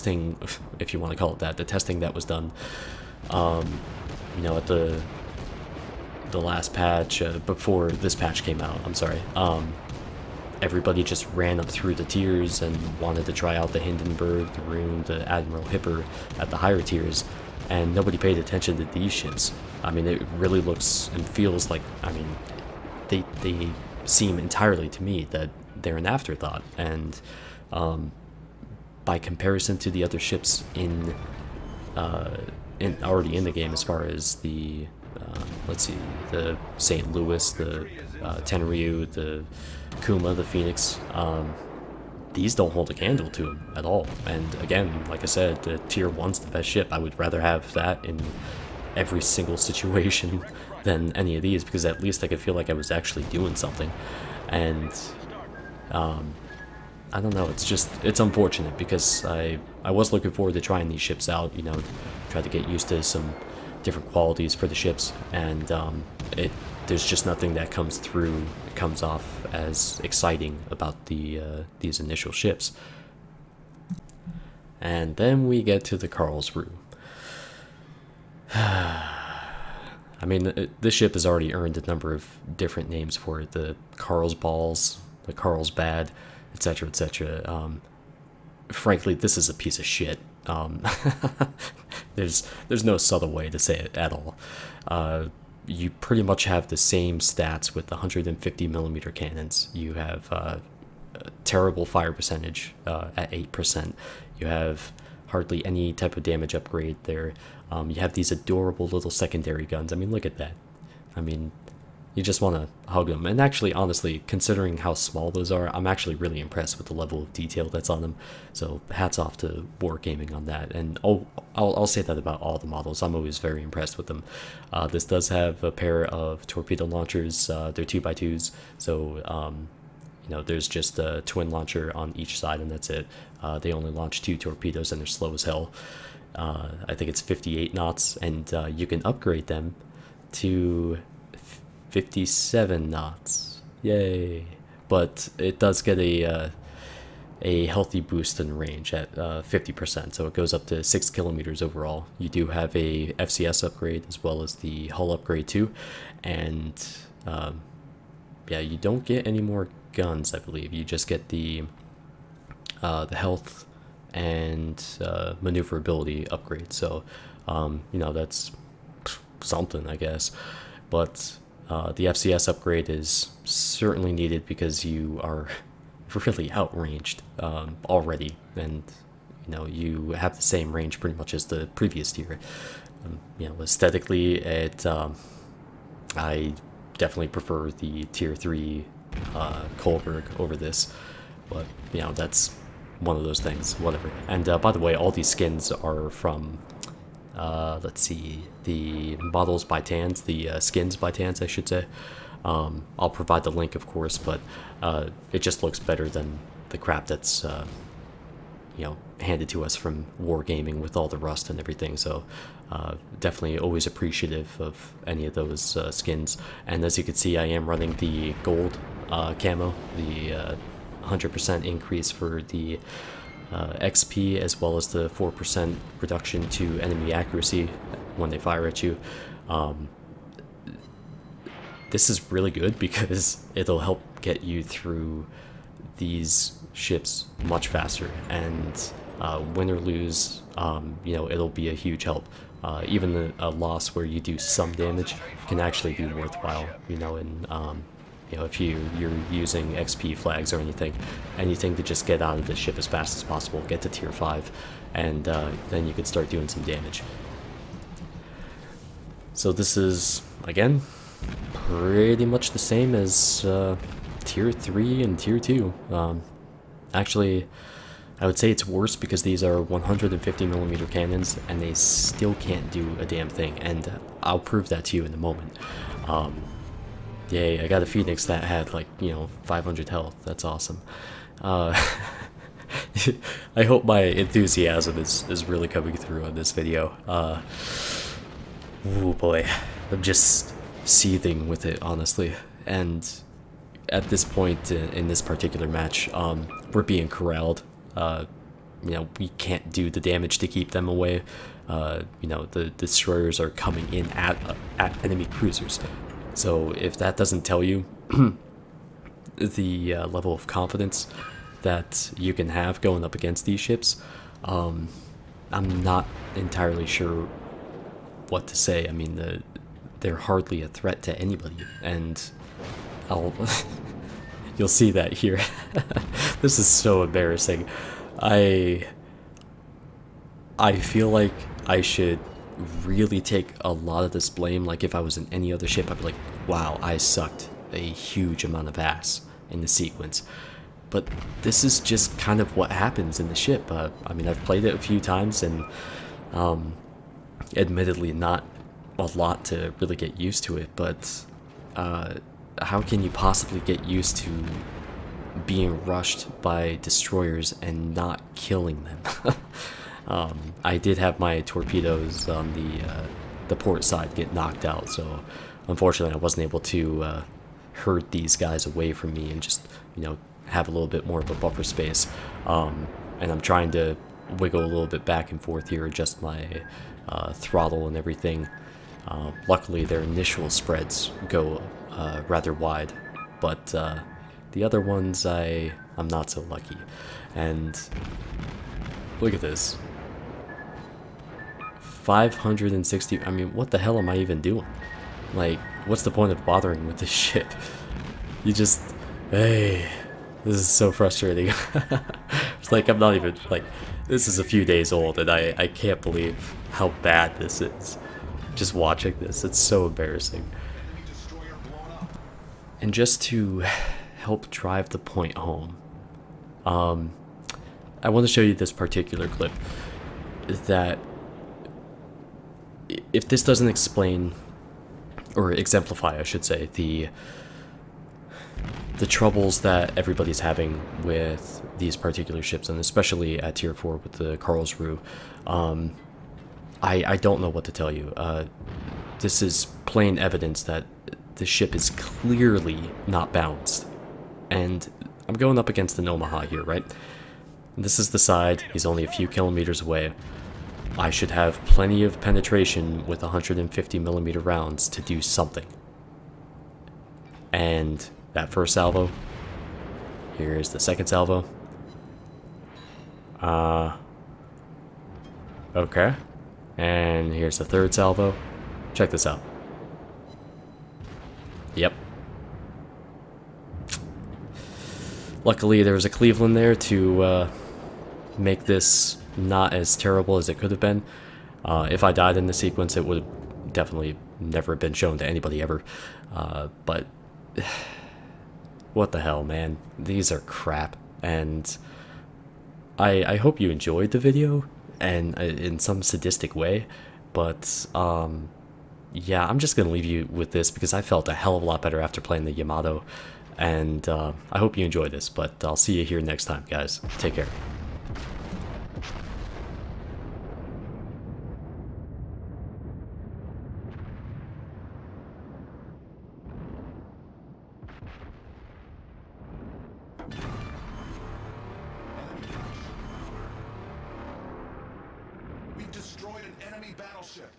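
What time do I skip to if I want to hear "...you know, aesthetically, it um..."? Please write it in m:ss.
3:03.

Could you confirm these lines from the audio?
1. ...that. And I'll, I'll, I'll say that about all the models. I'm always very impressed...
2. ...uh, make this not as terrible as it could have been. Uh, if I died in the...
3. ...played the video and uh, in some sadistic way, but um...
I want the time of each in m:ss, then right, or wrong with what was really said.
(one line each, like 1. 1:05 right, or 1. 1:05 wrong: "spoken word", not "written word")
1. 2:00 right
2. 7:57 right
3. 8:13 wrong: "enjoyed", not "played".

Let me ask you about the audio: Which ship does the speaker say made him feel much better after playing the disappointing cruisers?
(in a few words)
Yamato.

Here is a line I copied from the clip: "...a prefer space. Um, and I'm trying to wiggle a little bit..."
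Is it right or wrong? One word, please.
wrong.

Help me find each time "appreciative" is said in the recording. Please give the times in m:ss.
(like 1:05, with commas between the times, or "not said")
3:33.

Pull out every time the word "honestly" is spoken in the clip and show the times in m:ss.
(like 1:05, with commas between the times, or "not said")
1:53, 4:51.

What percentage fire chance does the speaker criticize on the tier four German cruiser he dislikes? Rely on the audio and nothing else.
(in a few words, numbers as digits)
8%.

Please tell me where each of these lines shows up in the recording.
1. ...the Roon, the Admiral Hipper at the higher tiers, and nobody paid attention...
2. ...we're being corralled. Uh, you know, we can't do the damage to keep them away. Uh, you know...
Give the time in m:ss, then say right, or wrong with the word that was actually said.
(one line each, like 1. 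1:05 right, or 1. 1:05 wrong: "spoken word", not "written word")
1. 0:14 right
2. 4:56 right.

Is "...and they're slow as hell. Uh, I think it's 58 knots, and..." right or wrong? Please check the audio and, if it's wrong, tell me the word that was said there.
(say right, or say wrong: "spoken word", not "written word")
right.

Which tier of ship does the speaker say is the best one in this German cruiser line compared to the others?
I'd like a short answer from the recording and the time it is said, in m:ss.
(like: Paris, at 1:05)
tier 1, at 0:45.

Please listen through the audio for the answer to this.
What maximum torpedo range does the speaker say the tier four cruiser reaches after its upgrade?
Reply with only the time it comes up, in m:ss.
2:30.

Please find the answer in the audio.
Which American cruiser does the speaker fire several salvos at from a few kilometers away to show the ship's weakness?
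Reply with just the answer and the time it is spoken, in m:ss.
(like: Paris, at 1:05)
Omaha, at 7:26.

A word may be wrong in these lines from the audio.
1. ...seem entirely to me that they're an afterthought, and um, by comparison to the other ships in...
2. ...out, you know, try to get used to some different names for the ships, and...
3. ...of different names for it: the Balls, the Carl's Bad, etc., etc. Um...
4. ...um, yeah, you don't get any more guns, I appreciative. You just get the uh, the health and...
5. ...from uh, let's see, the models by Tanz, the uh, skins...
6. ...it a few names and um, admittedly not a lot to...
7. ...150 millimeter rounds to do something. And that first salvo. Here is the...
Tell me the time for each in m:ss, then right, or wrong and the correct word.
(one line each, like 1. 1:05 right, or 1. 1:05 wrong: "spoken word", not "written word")
1. 0:24 right
2. 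1:01 wrong: "qualities", not "names"
3. 1:22 right
4. 2:37 wrong: "believe", not "appreciative"
5. 3:16 right
6. 5:44 wrong: "times", not "names"
7. 7:33 right.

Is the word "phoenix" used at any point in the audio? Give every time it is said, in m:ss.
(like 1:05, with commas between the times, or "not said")
0:40, 4:37.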